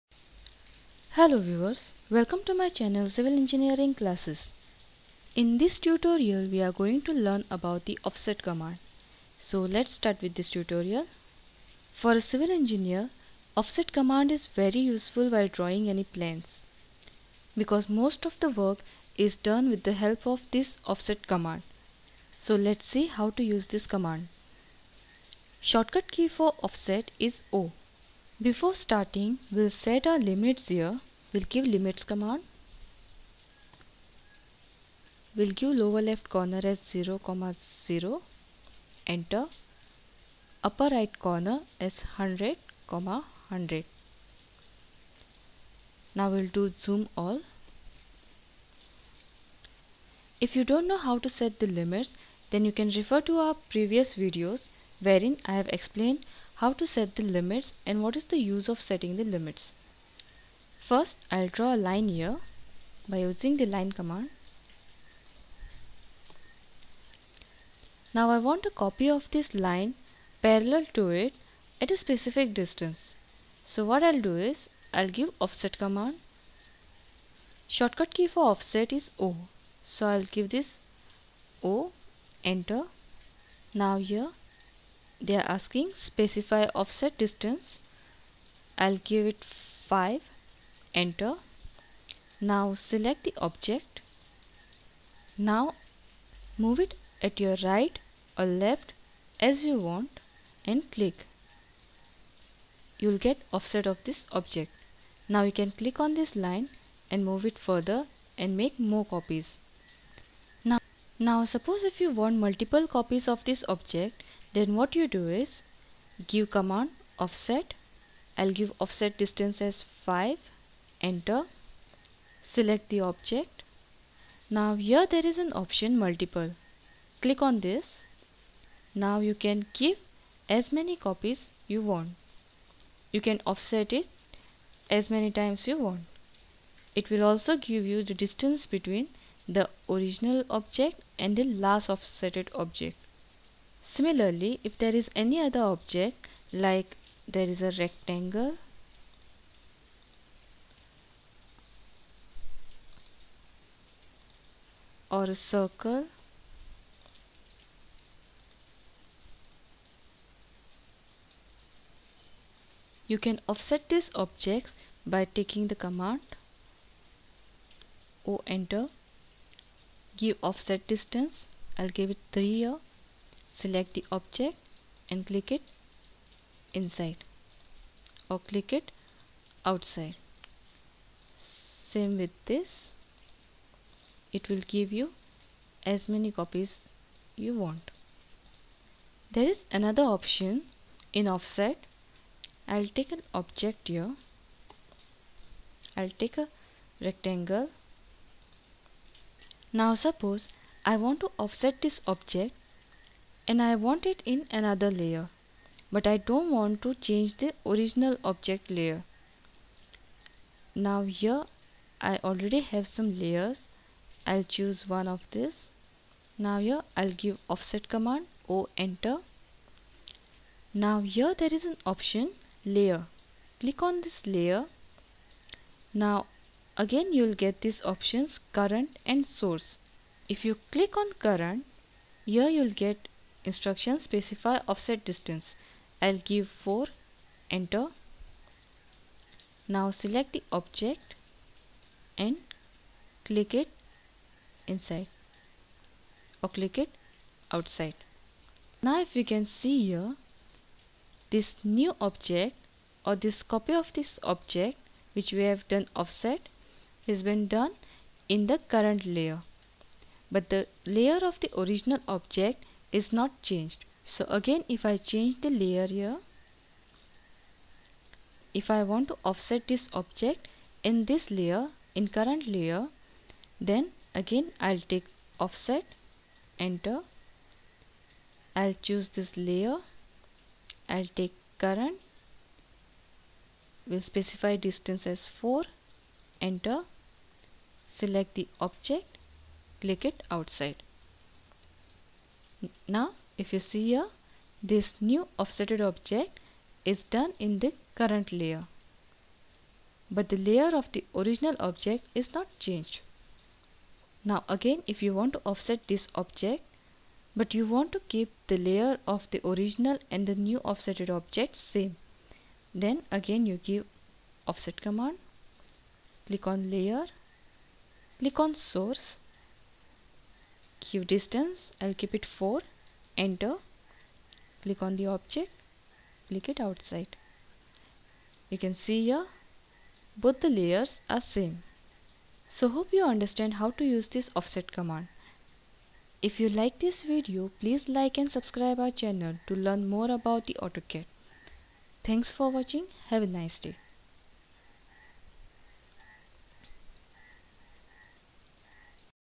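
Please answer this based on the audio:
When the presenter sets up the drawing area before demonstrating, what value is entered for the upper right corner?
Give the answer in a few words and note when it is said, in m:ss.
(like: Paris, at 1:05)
100,100, at 0:42.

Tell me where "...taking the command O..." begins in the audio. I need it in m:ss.
2:45.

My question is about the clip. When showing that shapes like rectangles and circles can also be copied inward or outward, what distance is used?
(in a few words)
3.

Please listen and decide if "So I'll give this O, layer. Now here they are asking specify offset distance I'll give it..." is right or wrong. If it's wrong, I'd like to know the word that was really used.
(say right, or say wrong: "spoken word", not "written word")
wrong: "enter", not "layer".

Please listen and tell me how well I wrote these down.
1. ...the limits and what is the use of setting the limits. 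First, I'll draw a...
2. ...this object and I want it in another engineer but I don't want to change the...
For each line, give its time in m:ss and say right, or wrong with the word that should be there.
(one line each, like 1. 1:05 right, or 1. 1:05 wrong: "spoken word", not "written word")
1. 0:57 right
2. 3:21 wrong: "layer", not "engineer".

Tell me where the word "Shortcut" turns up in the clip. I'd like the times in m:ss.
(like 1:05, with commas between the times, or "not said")
0:25, 1:17.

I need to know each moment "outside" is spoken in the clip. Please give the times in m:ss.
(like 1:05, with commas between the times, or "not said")
2:59, 4:07, 4:50, 5:26.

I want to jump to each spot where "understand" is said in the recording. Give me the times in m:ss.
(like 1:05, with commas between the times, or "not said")
5:33.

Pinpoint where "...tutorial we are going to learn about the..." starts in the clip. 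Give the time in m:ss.
0:05.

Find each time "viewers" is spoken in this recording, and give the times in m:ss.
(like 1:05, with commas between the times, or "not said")
0:01.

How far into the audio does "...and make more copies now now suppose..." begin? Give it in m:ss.
1:48.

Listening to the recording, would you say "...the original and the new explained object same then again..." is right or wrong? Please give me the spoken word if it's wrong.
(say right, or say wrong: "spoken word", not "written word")
wrong: "offsetted", not "explained".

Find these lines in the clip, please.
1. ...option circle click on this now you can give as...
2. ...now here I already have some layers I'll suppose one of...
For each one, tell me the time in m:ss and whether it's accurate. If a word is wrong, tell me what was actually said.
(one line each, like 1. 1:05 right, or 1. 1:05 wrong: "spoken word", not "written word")
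1. 2:05 wrong: "multiple", not "circle"
2. 3:30 wrong: "choose", not "suppose".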